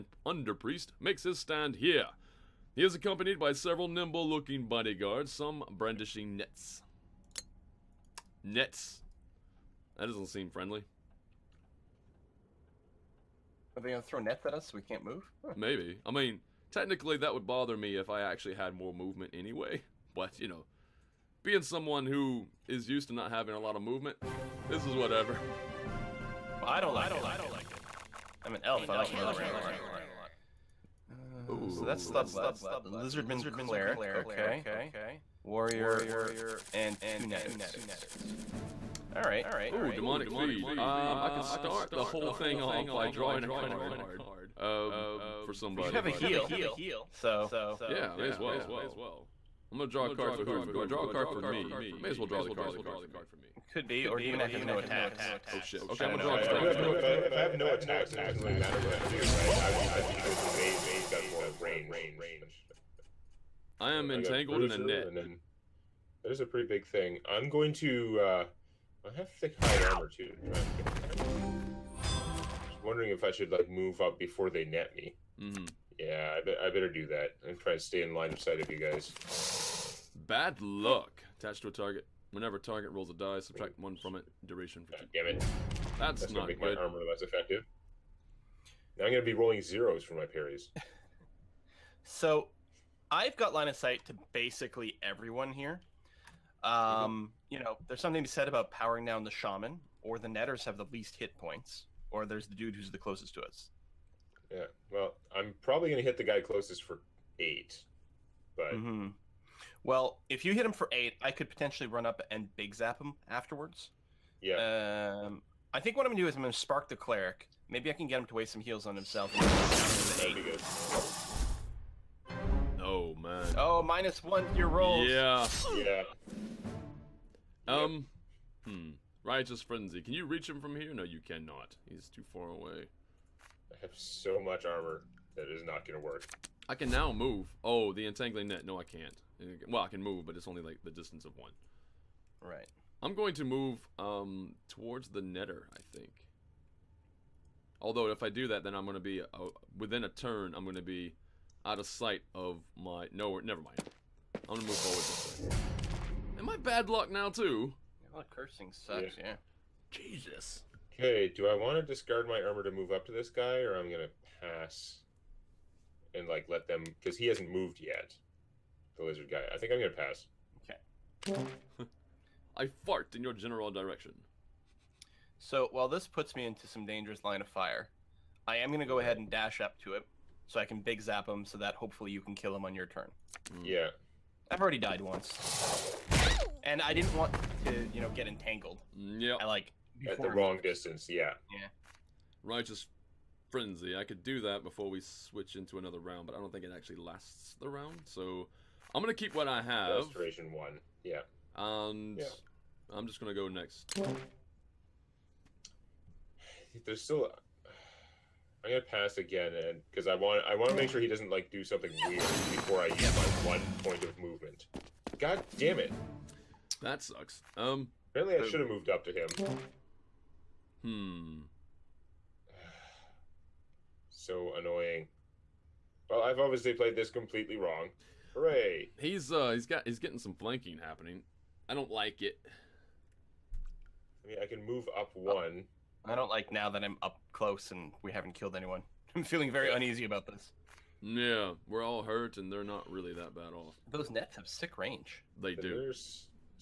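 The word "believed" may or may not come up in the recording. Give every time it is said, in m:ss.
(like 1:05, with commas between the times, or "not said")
not said.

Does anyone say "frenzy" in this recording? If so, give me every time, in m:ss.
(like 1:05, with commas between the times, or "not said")
2:09, 3:13.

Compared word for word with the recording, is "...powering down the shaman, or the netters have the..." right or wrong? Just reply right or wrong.
right.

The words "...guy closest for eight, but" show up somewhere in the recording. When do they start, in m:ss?
1:46.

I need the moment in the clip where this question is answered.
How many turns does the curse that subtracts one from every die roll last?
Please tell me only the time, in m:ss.
1:24.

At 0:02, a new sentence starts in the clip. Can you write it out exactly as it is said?
He is accompanied by several nimble-looking bodyguards, some brandishing nets.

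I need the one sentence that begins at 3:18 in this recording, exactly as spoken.
So I'm gonna keep what I have.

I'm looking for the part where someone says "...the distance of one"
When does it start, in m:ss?
2:20.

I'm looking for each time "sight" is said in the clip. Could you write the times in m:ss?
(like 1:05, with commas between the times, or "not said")
1:18, 1:33, 2:31.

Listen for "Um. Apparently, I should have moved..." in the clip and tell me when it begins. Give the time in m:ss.
3:37.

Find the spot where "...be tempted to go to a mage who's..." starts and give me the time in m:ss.
0:59.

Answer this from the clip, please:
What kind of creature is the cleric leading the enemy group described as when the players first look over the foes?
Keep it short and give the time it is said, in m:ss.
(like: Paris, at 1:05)
Lizardman, at 0:32.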